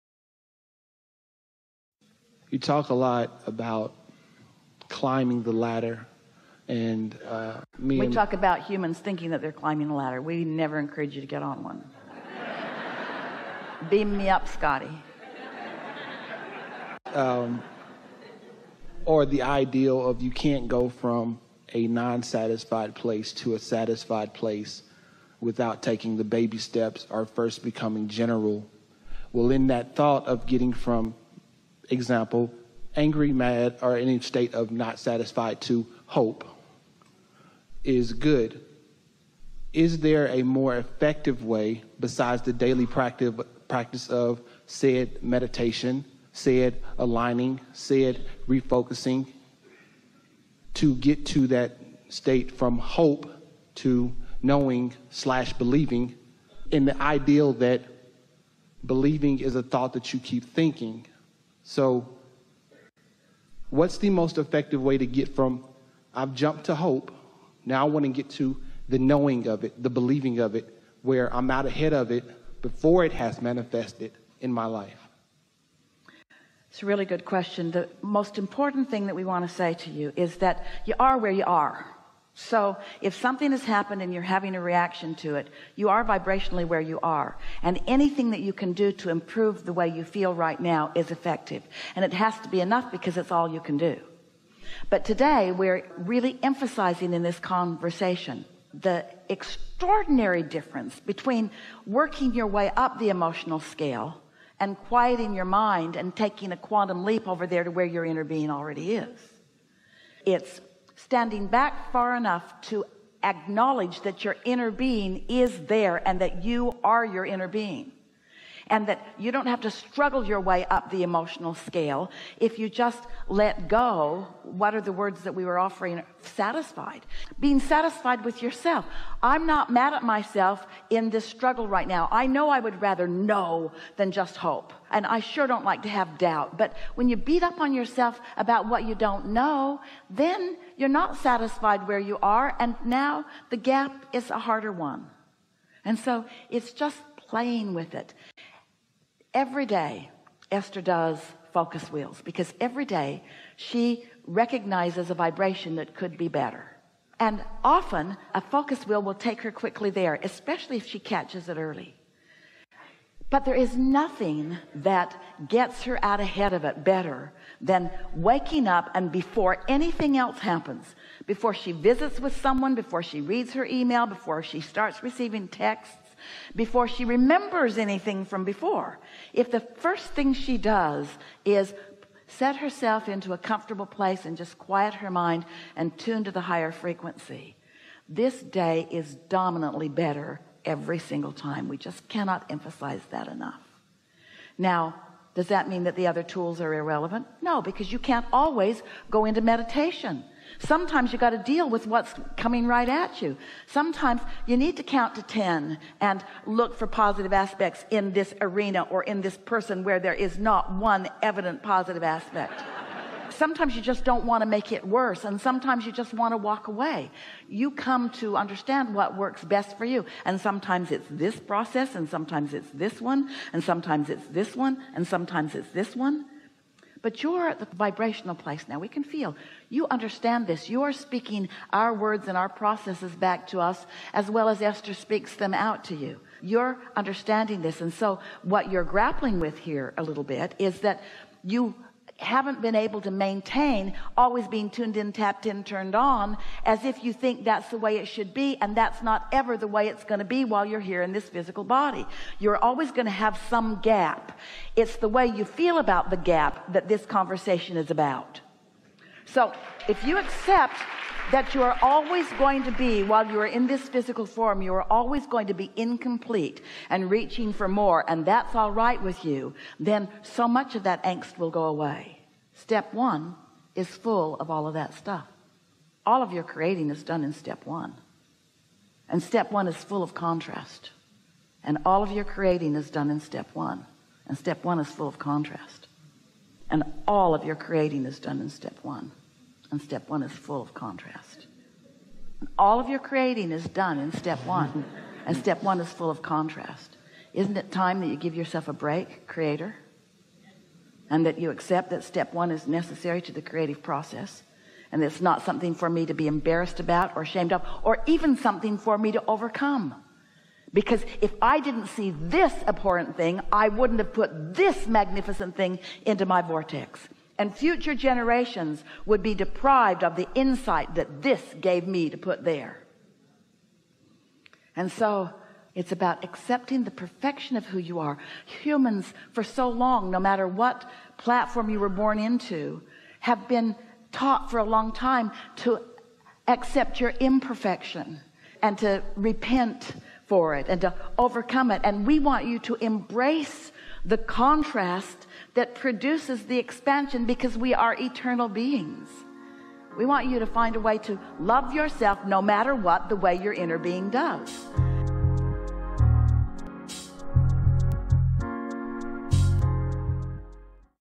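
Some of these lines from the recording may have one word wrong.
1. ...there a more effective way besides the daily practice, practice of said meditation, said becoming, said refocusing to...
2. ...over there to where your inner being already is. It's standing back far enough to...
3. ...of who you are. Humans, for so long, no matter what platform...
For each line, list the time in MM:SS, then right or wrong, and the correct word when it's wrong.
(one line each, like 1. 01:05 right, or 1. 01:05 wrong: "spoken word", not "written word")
1. 00:39 wrong: "aligning", not "becoming"
2. 01:47 right
3. 05:27 right.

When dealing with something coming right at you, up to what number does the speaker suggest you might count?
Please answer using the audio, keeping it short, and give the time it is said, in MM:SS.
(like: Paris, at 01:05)
10, at 03:25.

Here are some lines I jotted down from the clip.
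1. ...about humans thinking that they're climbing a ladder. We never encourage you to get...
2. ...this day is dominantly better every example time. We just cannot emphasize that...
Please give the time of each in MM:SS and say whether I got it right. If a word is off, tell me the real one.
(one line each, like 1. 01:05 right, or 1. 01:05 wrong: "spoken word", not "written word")
1. 00:08 right
2. 03:08 wrong: "single", not "example".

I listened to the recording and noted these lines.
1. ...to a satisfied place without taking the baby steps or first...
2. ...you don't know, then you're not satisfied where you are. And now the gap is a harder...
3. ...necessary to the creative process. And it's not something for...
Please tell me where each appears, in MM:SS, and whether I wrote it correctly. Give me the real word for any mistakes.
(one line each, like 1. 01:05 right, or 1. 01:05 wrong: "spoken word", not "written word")
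1. 00:23 right
2. 02:18 right
3. 05:02 right.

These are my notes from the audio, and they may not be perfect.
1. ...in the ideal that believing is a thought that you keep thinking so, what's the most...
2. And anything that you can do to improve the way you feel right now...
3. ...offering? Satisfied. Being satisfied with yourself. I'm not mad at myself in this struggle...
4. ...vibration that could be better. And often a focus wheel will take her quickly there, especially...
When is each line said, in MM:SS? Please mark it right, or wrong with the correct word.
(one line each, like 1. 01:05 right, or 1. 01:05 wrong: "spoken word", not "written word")
1. 00:56 right
2. 01:27 right
3. 02:05 right
4. 02:35 right.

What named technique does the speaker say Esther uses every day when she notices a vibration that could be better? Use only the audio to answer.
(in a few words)
focus wheels.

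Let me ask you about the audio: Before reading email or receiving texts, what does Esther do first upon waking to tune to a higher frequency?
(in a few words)
quiet her mind.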